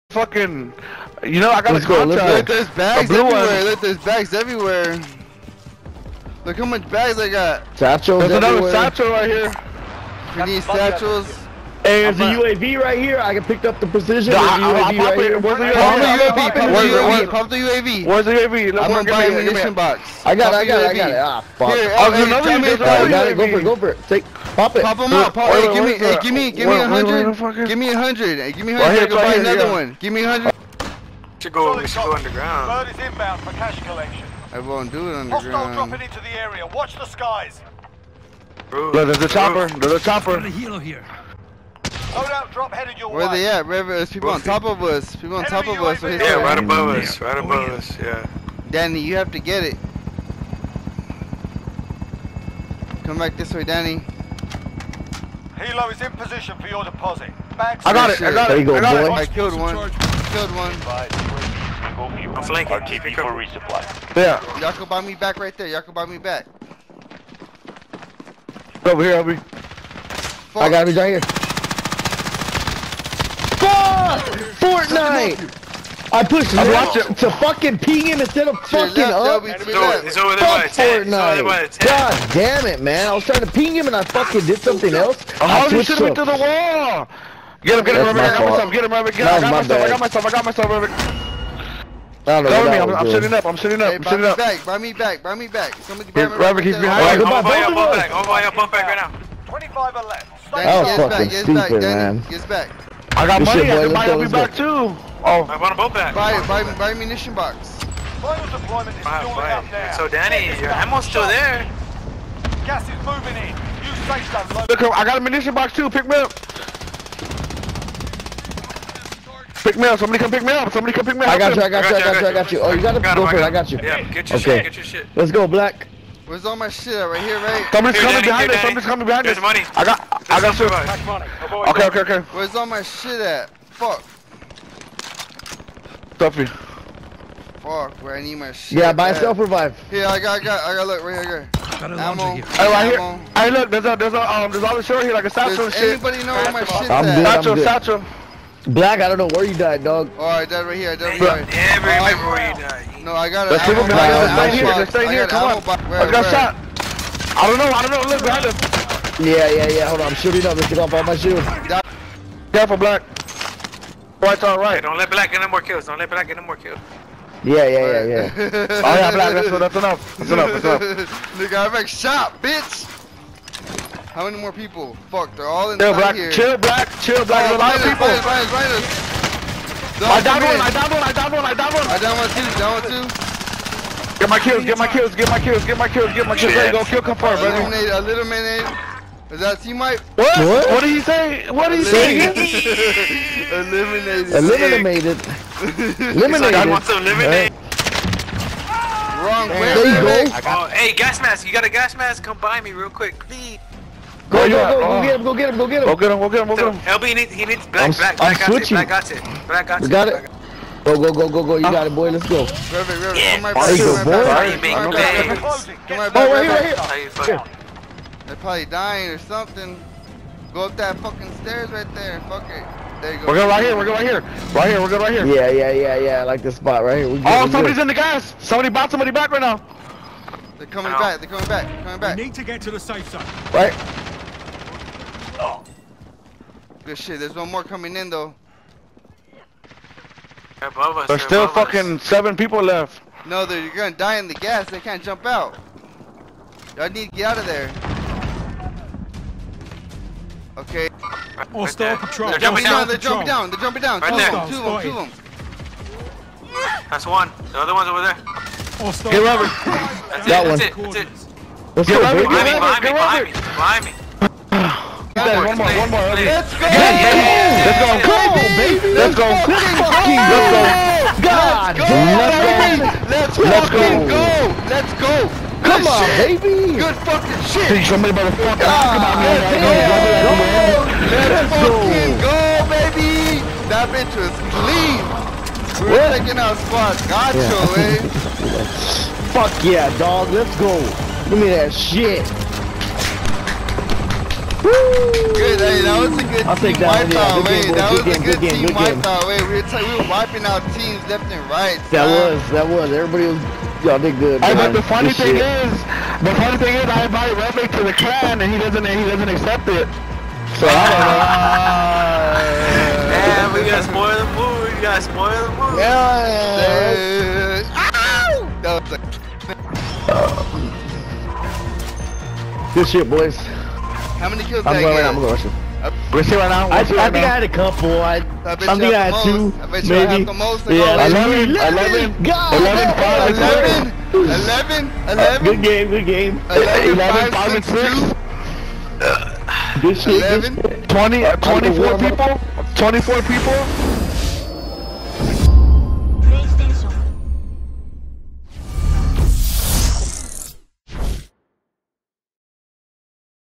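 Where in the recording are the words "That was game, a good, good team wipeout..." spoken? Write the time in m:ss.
4:57.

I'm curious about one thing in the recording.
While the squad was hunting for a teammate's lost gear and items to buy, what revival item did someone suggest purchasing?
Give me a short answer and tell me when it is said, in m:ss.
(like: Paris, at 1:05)
self revive, at 2:19.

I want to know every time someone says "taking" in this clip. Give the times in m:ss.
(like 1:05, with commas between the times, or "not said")
4:46.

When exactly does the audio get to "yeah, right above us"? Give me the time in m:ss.
0:46.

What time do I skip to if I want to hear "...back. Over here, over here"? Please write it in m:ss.
1:06.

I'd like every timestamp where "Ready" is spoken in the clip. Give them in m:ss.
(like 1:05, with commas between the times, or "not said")
3:06.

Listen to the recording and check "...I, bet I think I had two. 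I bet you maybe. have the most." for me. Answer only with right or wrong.
right.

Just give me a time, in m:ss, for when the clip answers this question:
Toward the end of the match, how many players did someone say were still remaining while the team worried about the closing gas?
4:02.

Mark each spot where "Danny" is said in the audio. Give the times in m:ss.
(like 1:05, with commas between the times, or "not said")
0:48, 0:53, 1:50, 2:08.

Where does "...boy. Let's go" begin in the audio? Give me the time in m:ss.
3:31.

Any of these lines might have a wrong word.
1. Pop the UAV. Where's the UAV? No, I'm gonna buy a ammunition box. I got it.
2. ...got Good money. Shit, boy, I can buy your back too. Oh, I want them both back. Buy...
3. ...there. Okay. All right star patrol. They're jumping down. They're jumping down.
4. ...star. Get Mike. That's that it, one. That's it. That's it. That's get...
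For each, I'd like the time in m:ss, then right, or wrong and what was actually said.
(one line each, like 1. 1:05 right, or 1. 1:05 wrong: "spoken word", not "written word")
1. 0:17 right
2. 1:43 right
3. 4:07 right
4. 4:18 wrong: "Robert", not "Mike".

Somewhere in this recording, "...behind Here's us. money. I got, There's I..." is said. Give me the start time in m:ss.
2:09.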